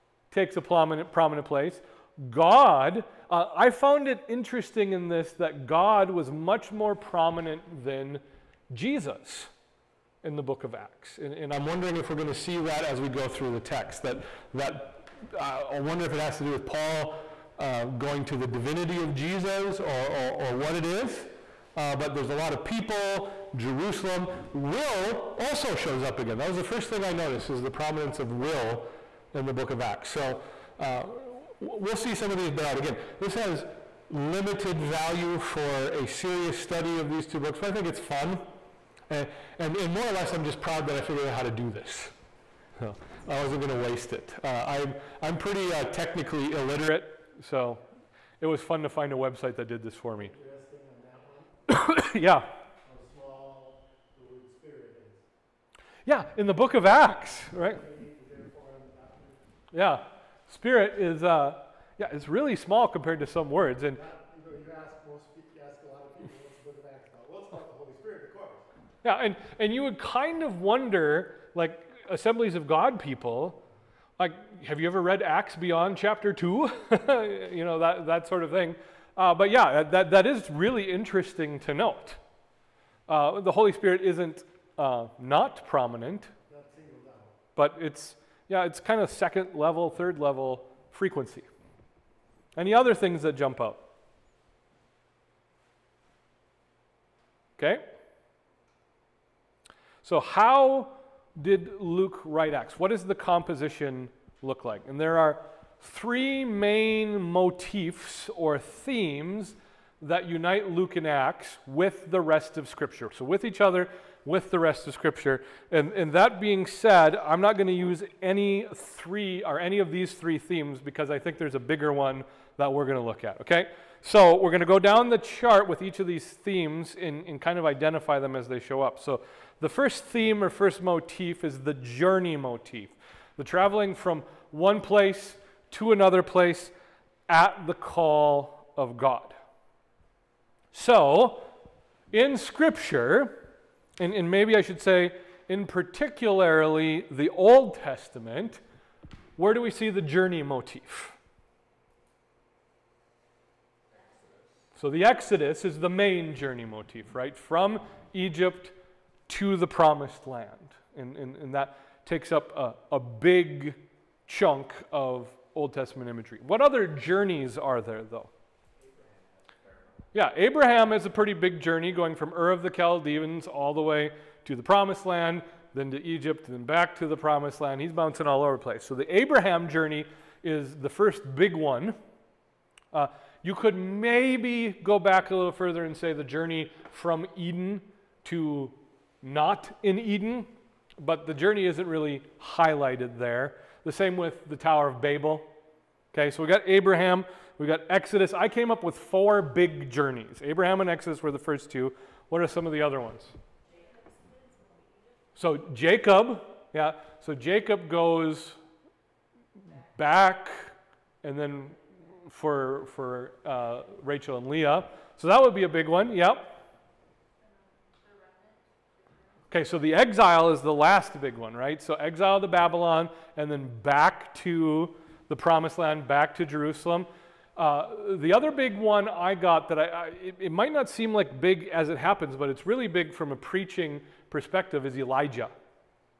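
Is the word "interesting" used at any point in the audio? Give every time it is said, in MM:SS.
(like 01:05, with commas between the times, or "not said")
00:04, 01:20.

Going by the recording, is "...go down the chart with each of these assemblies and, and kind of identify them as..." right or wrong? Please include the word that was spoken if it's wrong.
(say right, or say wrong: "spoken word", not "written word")
wrong: "themes", not "assemblies".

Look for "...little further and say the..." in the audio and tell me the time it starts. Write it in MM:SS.
03:05.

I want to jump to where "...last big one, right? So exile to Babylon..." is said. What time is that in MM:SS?
03:40.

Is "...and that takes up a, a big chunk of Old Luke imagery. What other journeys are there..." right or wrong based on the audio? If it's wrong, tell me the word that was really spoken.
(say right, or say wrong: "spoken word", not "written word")
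wrong: "Testament", not "Luke".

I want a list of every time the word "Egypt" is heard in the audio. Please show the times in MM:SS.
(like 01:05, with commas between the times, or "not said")
02:38, 02:56.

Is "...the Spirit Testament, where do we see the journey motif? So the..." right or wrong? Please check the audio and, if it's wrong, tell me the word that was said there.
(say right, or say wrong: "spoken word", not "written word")
wrong: "Old", not "Spirit".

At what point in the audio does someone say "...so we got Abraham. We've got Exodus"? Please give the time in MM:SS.
03:16.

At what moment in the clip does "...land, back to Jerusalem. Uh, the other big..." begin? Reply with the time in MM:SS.
03:45.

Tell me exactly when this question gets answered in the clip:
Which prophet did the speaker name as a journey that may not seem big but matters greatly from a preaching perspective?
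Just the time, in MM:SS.
03:54.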